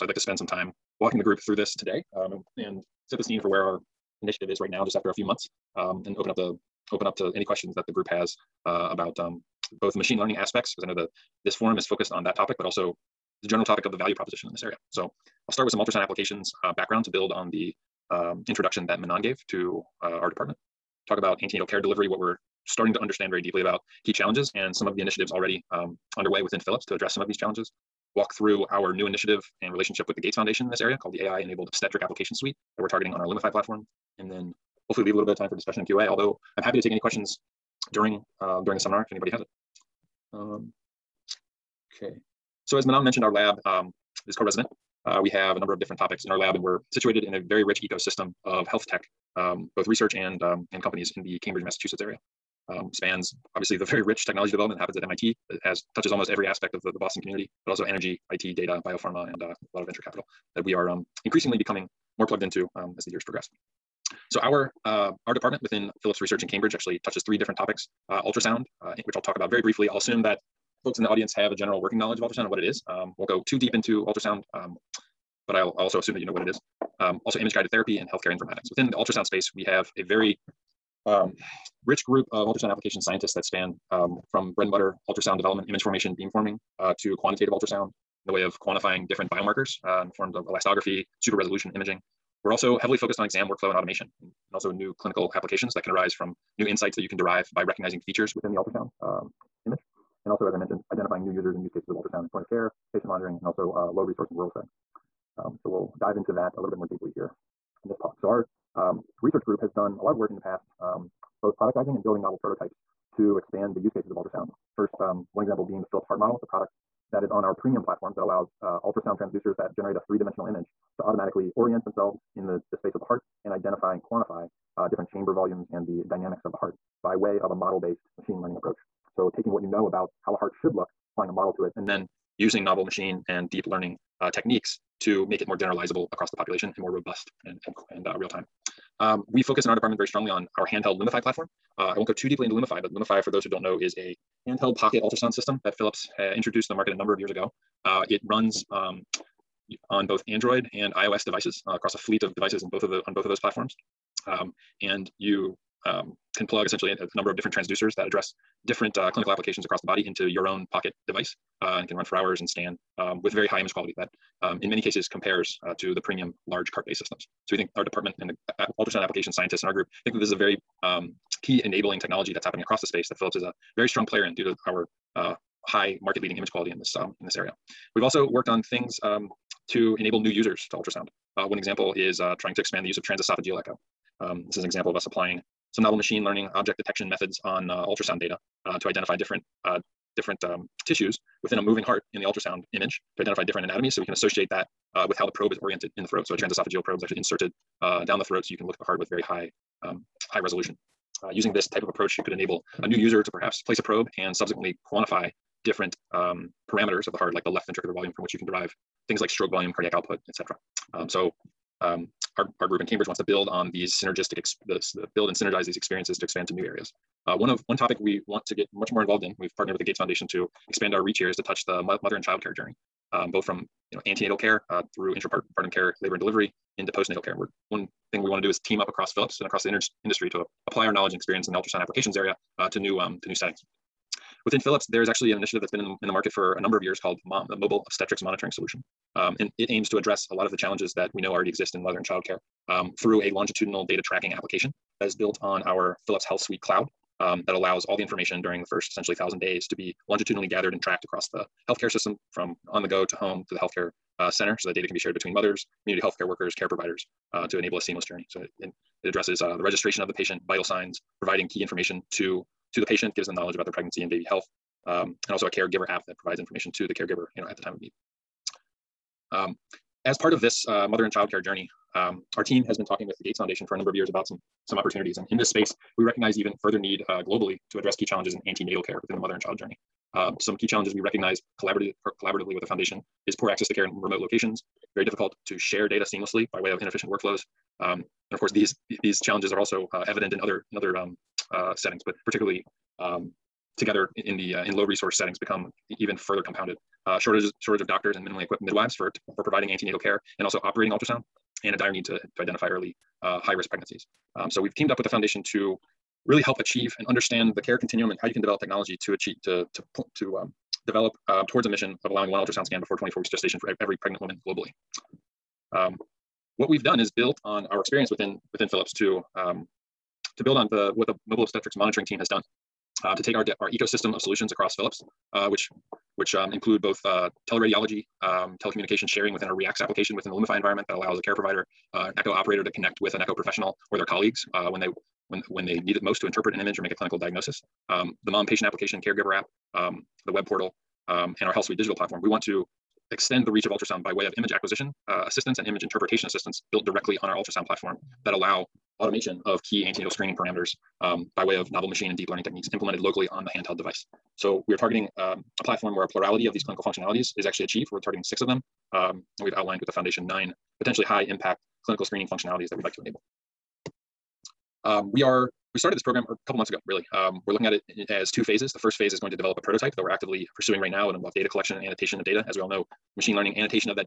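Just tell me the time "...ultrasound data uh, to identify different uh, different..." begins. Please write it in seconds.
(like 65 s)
187 s.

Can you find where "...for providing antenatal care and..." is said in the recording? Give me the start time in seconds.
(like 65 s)
299 s.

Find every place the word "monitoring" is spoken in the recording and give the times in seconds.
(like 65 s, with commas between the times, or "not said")
103 s, 238 s, 321 s.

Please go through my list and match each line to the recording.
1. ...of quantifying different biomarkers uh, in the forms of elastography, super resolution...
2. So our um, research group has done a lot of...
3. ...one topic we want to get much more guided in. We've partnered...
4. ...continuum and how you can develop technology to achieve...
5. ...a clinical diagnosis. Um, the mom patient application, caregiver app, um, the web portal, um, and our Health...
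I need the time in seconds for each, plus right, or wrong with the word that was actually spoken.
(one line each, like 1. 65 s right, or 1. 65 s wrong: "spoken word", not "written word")
1. 88 s right
2. 108 s right
3. 217 s wrong: "involved", not "guided"
4. 307 s right
5. 336 s right.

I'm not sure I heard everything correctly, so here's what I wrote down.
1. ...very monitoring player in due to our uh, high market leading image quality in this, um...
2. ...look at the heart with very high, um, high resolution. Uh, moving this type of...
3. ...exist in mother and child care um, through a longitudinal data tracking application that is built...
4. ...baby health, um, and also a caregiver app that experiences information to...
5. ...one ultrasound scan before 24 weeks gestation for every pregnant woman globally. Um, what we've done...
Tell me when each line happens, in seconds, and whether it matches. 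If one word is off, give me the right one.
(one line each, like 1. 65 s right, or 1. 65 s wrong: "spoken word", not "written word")
1. 173 s wrong: "strong", not "monitoring"
2. 198 s wrong: "using", not "moving"
3. 241 s right
4. 264 s wrong: "provides", not "experiences"
5. 312 s right.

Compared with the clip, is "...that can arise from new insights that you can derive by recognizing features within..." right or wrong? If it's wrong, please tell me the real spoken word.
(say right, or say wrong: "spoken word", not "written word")
right.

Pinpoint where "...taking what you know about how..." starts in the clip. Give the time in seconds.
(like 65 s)
129 s.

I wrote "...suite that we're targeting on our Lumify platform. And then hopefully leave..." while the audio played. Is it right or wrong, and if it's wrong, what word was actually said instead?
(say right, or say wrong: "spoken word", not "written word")
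right.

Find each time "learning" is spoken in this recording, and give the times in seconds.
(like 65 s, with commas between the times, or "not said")
10 s, 128 s, 133 s, 186 s, 352 s, 373 s.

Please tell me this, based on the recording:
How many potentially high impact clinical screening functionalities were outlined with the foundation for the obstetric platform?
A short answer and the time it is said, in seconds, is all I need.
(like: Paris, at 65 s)
9, at 360 s.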